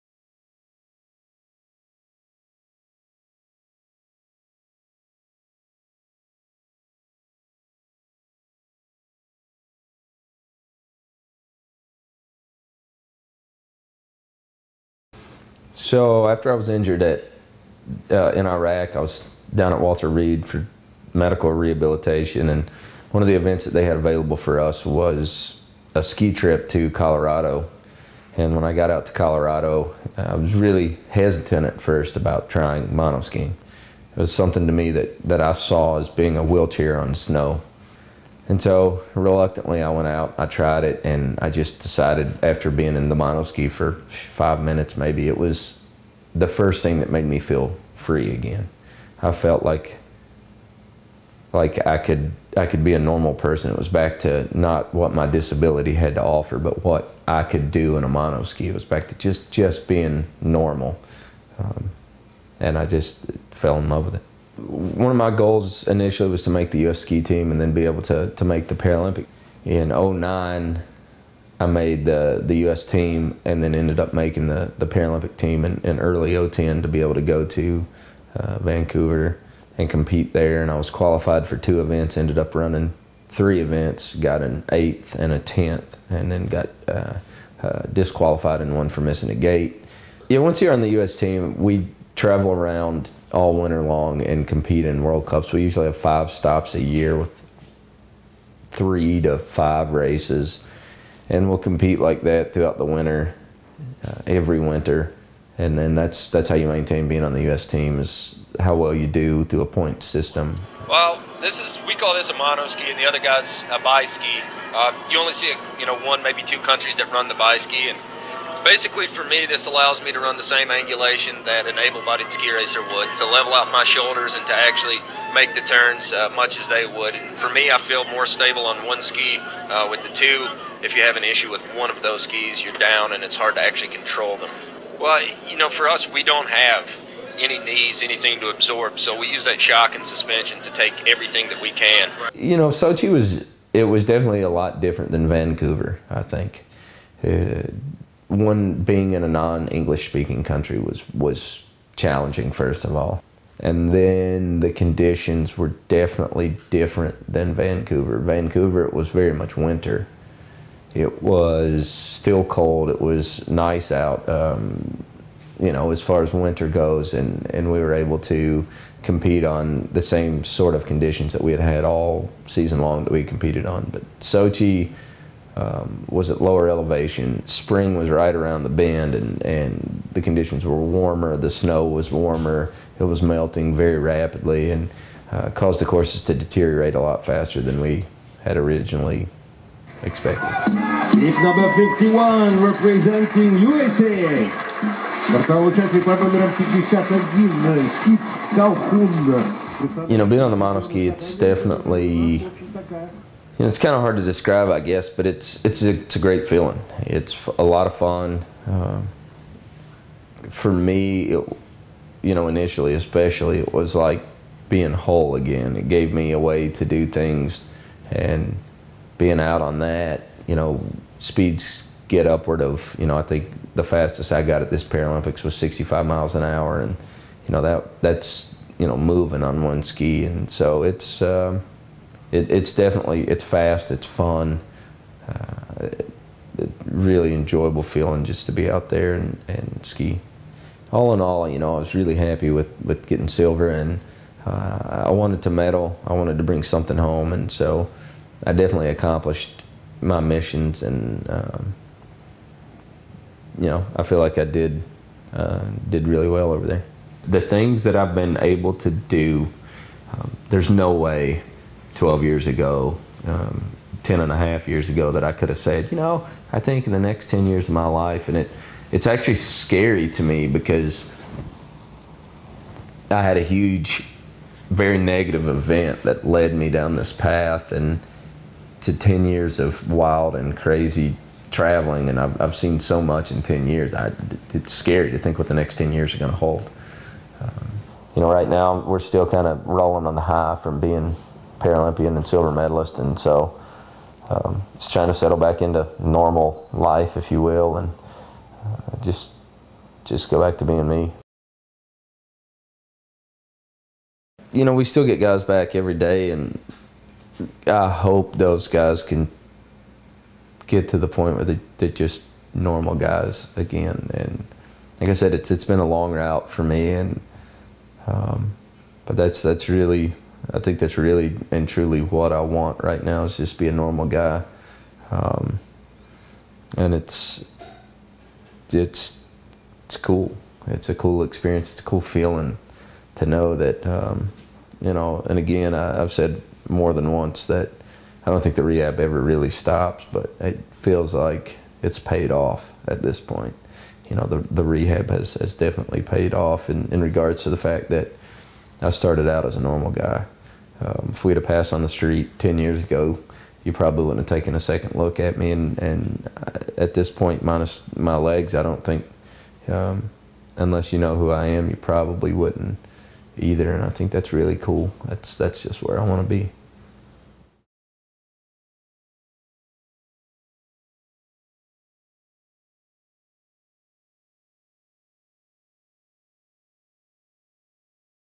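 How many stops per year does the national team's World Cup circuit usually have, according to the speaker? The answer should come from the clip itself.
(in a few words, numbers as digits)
5.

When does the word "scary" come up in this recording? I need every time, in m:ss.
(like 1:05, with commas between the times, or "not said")
4:29, 4:44.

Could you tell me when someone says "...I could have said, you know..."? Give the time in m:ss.
4:25.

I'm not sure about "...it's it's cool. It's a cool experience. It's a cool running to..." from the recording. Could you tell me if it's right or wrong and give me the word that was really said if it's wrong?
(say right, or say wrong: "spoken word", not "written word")
wrong: "feeling", not "running".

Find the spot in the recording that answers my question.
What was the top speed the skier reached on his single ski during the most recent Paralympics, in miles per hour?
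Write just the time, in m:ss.
3:45.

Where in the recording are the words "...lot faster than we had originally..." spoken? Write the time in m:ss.
3:06.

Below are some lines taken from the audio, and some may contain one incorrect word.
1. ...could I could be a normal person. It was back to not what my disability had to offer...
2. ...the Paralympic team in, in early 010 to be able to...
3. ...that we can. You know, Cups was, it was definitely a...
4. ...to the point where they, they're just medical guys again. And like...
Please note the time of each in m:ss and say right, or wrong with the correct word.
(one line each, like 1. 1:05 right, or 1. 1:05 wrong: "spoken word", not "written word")
1. 0:51 right
2. 1:14 right
3. 2:21 wrong: "Sochi", not "Cups"
4. 5:10 wrong: "normal", not "medical".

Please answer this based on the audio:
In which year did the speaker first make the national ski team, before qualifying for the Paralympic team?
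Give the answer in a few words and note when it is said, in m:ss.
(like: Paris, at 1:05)
2009, at 1:09.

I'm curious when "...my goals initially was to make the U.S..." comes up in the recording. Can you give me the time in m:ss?
1:05.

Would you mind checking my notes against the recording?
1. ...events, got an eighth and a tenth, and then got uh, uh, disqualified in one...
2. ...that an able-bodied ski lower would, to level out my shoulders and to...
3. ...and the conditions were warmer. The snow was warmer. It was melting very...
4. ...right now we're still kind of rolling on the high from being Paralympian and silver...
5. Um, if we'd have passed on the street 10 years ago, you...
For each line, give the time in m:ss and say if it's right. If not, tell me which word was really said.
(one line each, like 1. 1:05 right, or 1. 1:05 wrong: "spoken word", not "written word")
1. 1:23 right
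2. 2:01 wrong: "racer", not "lower"
3. 2:59 right
4. 4:48 right
5. 5:50 right.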